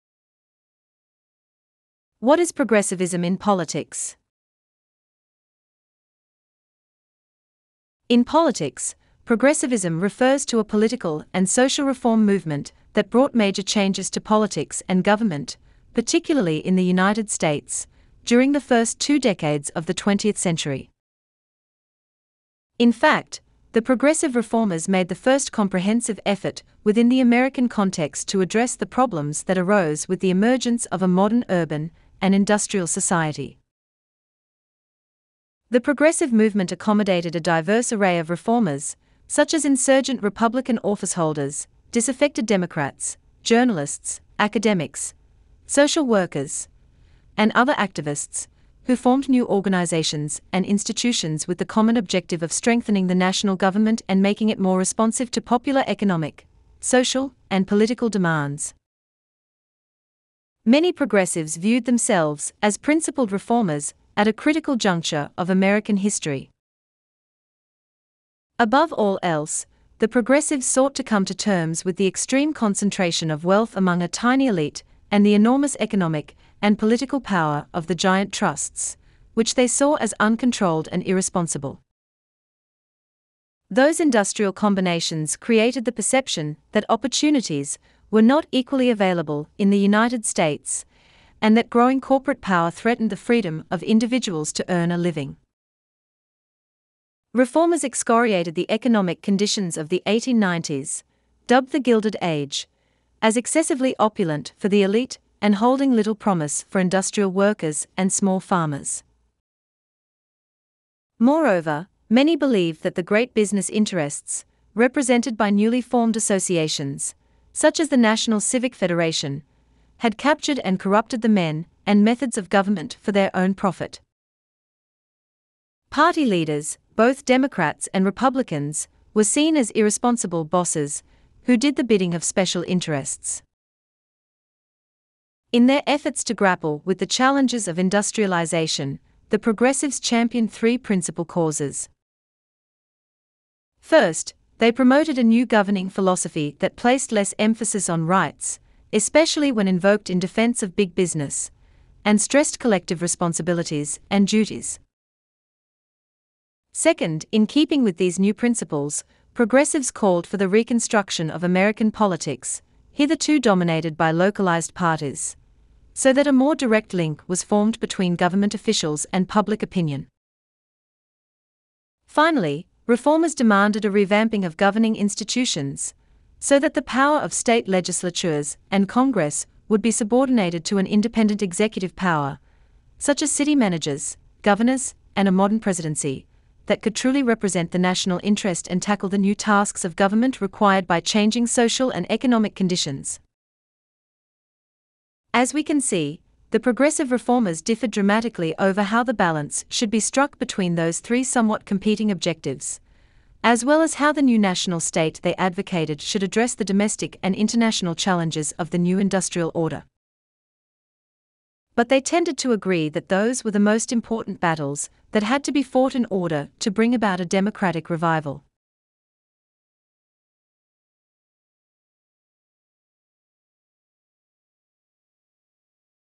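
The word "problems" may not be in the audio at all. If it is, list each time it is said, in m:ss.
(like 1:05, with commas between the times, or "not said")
0:28.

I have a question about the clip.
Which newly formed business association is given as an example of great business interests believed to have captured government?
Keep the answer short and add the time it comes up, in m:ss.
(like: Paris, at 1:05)
National Civic Federation, at 1:57.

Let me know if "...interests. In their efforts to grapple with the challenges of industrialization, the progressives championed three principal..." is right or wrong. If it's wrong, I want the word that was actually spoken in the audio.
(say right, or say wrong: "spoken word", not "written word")
right.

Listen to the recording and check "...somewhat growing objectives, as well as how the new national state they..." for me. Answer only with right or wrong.
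wrong.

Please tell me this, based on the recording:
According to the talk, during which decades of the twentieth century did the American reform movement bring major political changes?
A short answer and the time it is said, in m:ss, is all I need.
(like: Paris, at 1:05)
first two decades, at 0:18.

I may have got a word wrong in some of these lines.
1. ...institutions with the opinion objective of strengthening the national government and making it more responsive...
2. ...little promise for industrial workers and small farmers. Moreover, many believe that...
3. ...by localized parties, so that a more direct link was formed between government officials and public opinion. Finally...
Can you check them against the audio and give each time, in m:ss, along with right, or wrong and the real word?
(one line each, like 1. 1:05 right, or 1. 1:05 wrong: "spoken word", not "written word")
1. 0:50 wrong: "common", not "opinion"
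2. 1:45 right
3. 2:43 right.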